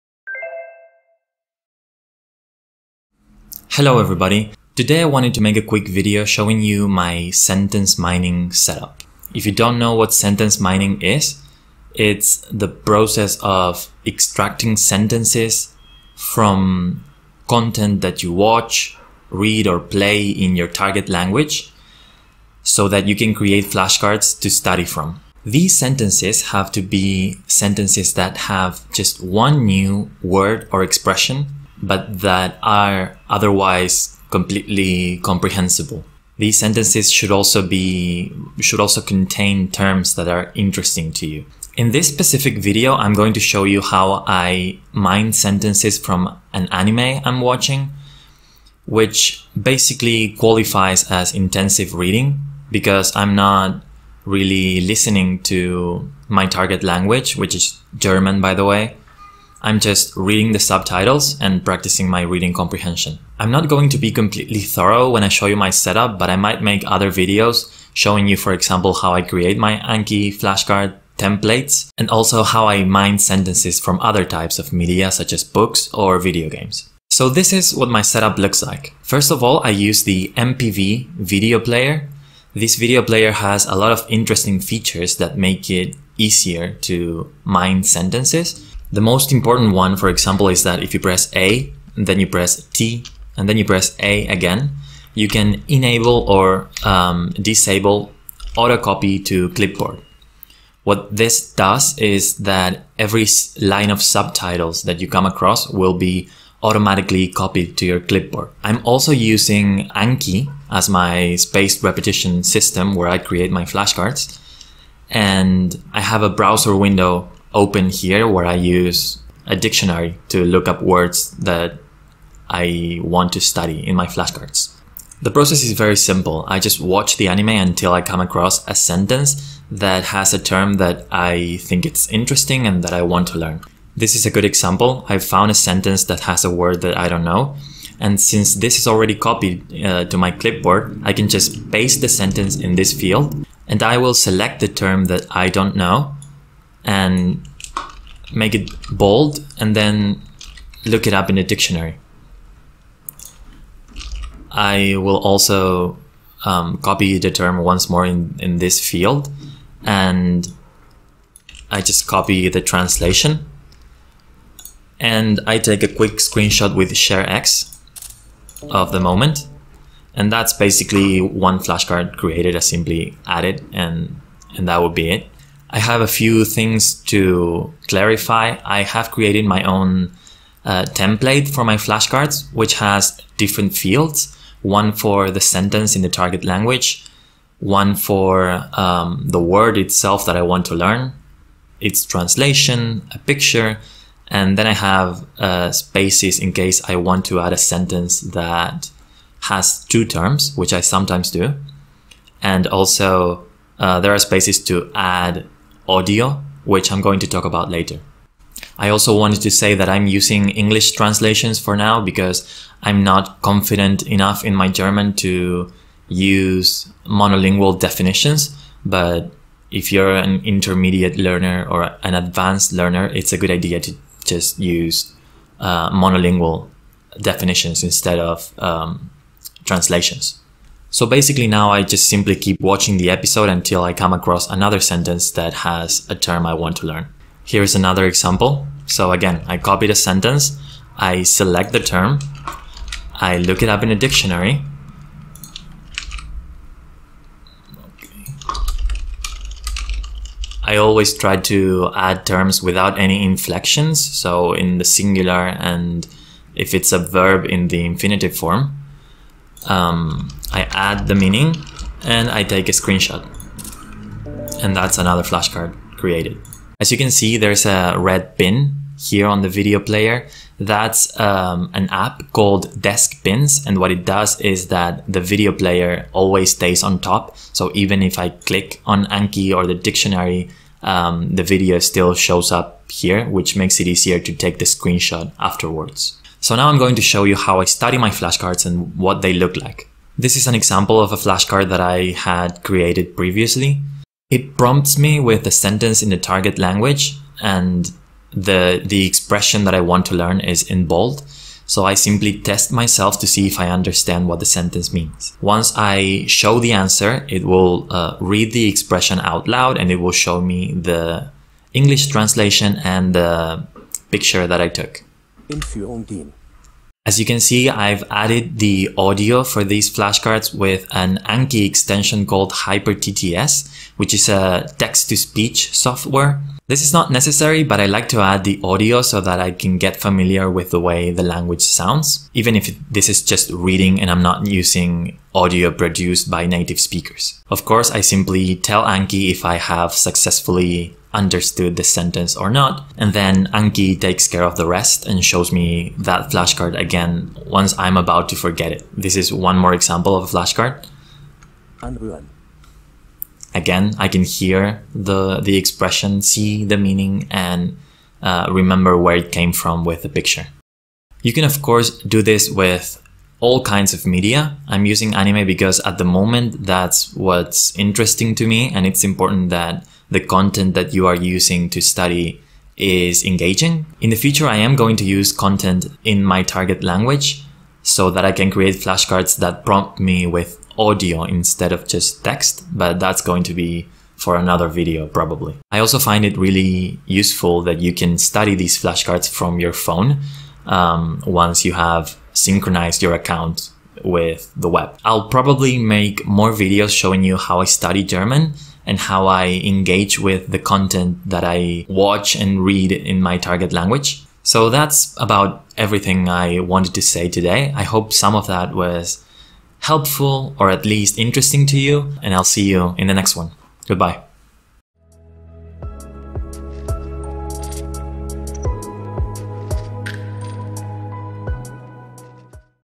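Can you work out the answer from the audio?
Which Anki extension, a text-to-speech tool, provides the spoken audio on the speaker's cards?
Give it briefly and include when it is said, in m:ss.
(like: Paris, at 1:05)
HyperTTS, at 5:22.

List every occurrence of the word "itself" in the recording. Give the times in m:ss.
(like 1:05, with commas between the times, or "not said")
3:09.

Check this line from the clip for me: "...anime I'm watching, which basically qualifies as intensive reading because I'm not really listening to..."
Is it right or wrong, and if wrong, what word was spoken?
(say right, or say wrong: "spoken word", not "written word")
right.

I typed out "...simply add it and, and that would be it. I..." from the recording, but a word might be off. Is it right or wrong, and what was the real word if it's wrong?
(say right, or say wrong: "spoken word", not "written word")
right.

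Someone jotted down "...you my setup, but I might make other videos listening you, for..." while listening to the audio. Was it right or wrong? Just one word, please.
wrong.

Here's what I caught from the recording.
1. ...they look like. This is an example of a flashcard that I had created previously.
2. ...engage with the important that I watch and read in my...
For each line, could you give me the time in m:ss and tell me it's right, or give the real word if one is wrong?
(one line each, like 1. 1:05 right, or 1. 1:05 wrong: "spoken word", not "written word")
1. 4:49 right
2. 6:39 wrong: "content", not "important".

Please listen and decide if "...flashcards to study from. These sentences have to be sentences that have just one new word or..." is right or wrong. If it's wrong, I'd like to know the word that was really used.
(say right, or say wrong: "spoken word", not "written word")
right.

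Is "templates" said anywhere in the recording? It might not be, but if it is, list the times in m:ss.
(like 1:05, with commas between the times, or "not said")
1:11, 3:00.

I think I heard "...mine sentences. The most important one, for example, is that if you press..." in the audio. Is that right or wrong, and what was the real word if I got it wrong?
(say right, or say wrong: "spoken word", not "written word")
right.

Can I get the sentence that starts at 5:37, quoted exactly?
Of course, I simply tell Anki if I have successfully understood the sentence or not.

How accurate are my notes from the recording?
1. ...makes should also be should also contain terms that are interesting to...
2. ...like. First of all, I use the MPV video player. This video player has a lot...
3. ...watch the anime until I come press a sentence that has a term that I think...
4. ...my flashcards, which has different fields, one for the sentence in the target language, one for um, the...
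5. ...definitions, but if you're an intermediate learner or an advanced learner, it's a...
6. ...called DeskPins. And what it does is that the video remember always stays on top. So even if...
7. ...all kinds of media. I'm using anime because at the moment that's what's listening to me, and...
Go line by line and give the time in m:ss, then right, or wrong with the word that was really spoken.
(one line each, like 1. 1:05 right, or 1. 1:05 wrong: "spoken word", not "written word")
1. 0:36 wrong: "sentences", not "makes"
2. 1:18 right
3. 2:06 wrong: "across", not "press"
4. 3:01 right
5. 3:37 right
6. 4:32 wrong: "player", not "remember"
7. 6:03 wrong: "interesting", not "listening".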